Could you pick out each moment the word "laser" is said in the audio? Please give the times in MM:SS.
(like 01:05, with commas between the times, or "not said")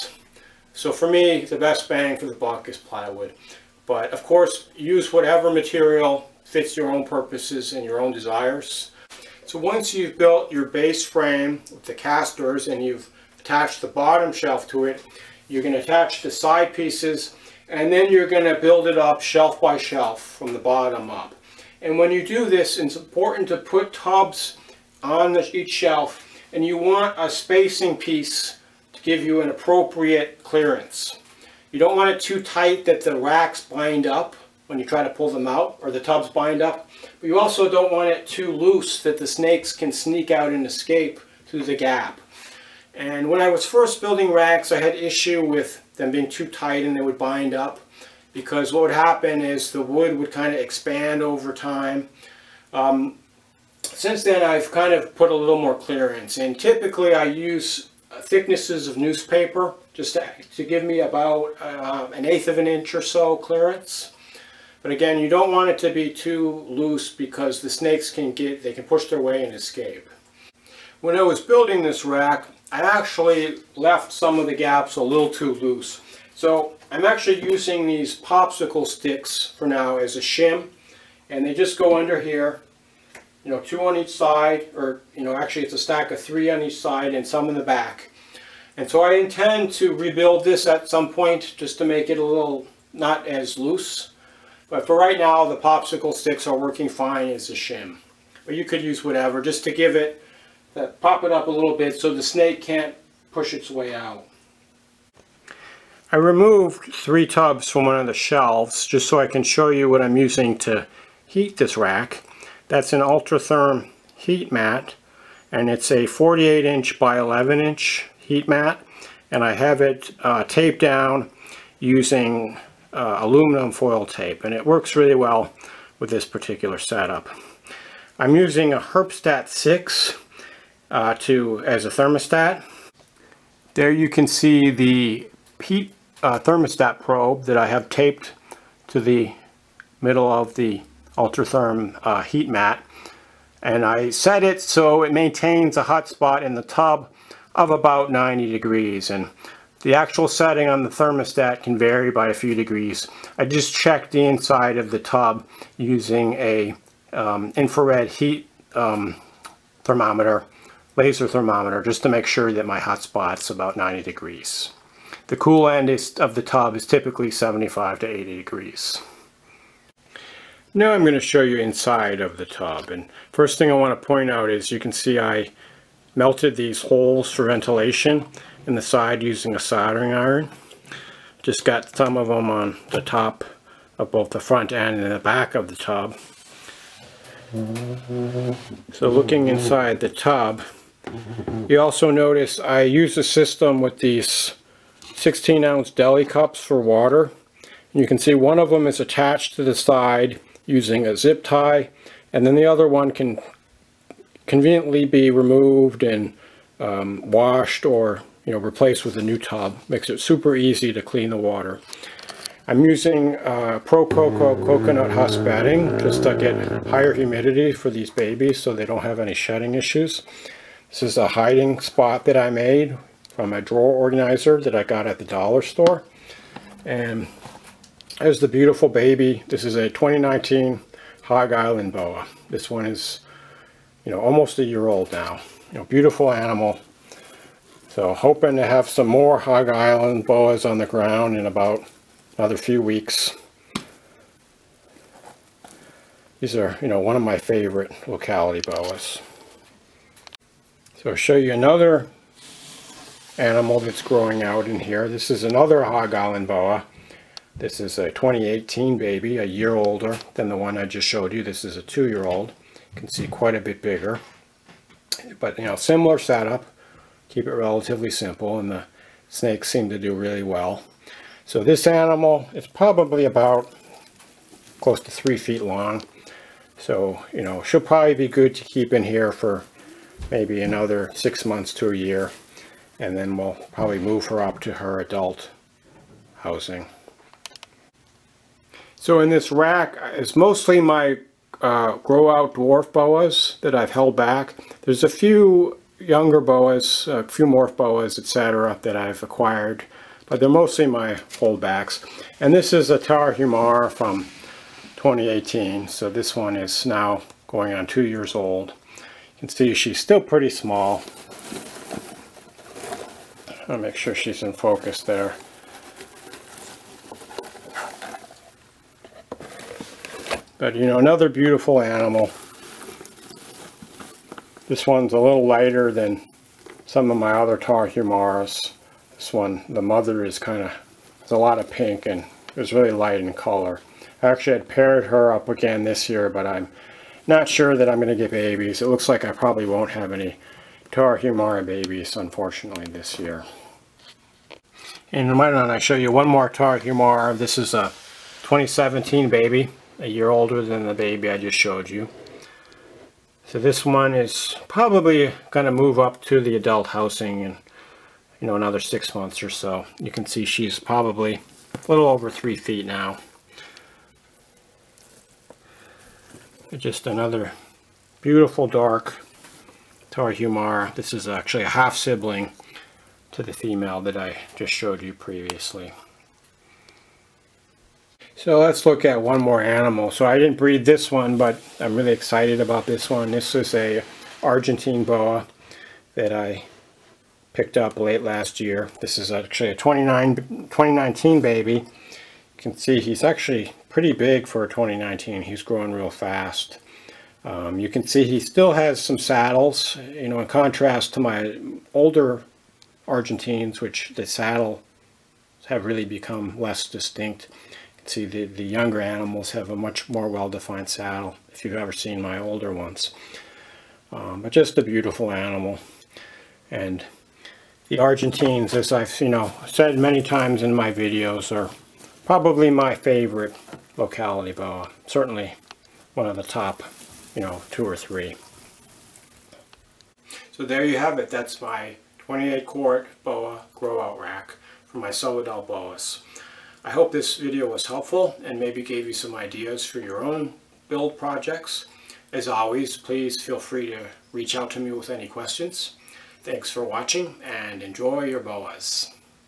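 02:40.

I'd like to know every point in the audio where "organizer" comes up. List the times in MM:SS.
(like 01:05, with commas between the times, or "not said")
03:43.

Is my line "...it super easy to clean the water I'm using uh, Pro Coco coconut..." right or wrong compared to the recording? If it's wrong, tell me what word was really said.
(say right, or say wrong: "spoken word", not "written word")
right.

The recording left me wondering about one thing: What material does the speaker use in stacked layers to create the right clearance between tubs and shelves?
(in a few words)
newspaper.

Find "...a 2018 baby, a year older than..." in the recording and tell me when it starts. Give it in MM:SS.
04:17.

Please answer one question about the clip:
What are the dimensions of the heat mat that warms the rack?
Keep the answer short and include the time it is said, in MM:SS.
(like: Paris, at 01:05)
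48 inch by 11 inch, at 01:56.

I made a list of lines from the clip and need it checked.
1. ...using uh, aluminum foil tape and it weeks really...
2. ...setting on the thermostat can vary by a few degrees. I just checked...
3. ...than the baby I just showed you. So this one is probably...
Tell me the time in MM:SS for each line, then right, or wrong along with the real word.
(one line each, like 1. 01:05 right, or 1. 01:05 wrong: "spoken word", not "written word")
1. 02:01 wrong: "works", not "weeks"
2. 02:30 right
3. 05:50 right.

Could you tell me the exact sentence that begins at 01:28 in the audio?
And so I intend to rebuild this at some point just to make it a little not as loose.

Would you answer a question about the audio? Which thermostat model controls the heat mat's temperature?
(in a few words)
Herpstat 6.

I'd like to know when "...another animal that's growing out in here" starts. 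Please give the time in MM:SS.
04:11.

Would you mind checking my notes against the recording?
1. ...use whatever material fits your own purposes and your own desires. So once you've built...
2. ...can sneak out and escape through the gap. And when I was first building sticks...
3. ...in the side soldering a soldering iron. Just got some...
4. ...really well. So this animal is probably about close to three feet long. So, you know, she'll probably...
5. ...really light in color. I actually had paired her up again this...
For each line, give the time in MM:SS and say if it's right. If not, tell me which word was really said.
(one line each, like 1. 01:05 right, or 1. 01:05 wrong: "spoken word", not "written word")
1. 00:04 right
2. 00:39 wrong: "racks", not "sticks"
3. 02:58 wrong: "using", not "soldering"
4. 04:30 right
5. 05:32 right.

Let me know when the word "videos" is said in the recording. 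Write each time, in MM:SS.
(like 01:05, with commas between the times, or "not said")
07:00, 07:17.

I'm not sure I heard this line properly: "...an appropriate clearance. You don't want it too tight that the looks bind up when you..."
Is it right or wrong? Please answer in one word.
wrong.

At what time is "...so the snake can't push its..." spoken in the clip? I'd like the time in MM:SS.
01:41.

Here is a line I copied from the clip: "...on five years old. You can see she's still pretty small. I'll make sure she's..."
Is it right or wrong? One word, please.
wrong.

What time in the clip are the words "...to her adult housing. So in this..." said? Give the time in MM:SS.
04:44.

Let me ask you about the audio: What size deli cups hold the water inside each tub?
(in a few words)
16 ounce.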